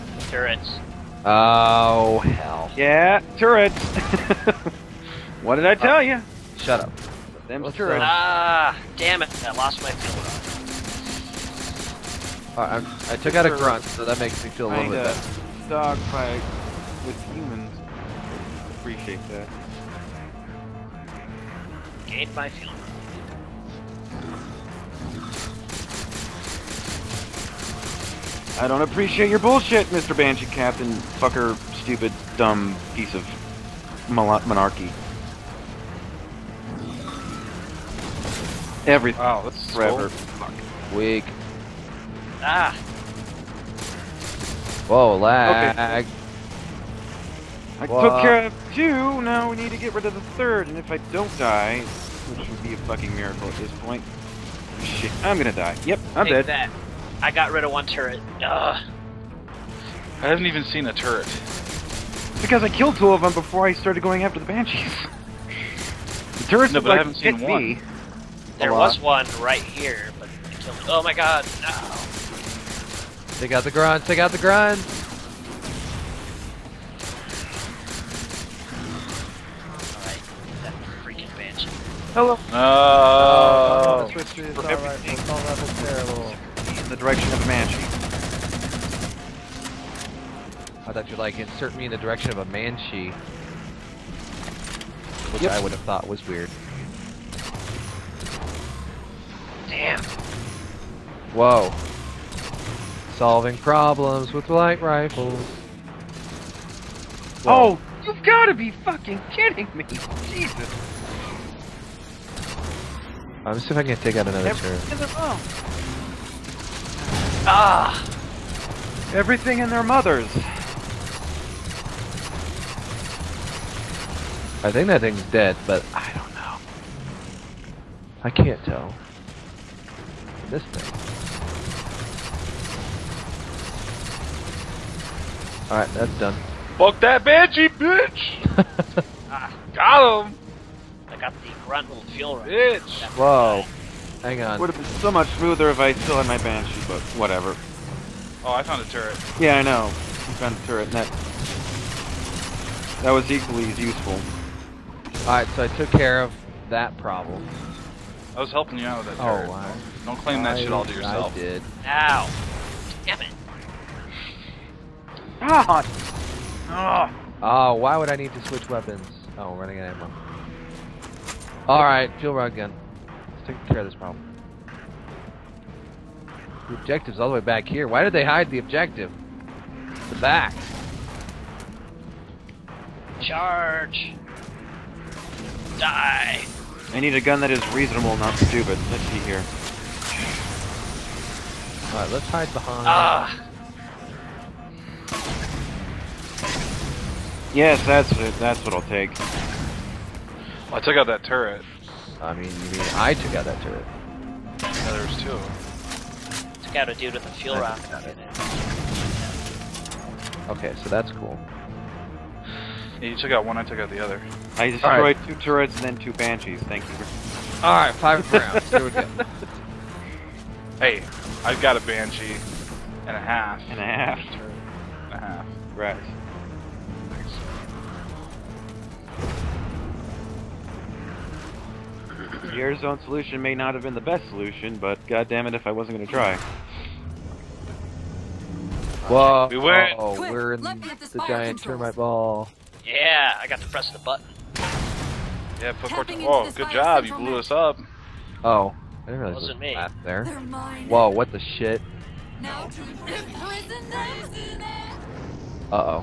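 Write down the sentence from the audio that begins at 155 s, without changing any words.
Alright, so I took care of that problem.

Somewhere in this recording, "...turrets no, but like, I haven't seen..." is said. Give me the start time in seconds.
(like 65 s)
66 s.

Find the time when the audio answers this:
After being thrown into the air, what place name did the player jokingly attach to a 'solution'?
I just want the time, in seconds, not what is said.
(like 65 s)
232 s.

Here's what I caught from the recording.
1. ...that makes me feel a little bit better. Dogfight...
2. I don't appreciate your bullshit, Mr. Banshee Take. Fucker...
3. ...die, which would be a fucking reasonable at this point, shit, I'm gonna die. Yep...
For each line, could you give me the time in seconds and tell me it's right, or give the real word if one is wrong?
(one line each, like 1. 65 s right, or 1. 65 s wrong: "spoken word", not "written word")
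1. 14 s right
2. 28 s wrong: "Captain", not "Take"
3. 51 s wrong: "miracle", not "reasonable".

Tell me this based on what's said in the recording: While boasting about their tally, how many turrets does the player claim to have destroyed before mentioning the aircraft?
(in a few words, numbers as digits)
2.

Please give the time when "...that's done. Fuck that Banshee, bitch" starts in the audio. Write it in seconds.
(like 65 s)
135 s.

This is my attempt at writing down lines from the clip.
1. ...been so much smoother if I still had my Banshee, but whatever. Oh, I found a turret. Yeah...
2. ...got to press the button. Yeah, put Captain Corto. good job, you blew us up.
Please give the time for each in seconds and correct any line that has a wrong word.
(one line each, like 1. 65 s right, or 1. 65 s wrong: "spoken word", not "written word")
1. 144 s right
2. 243 s wrong: "Tapping", not "Captain".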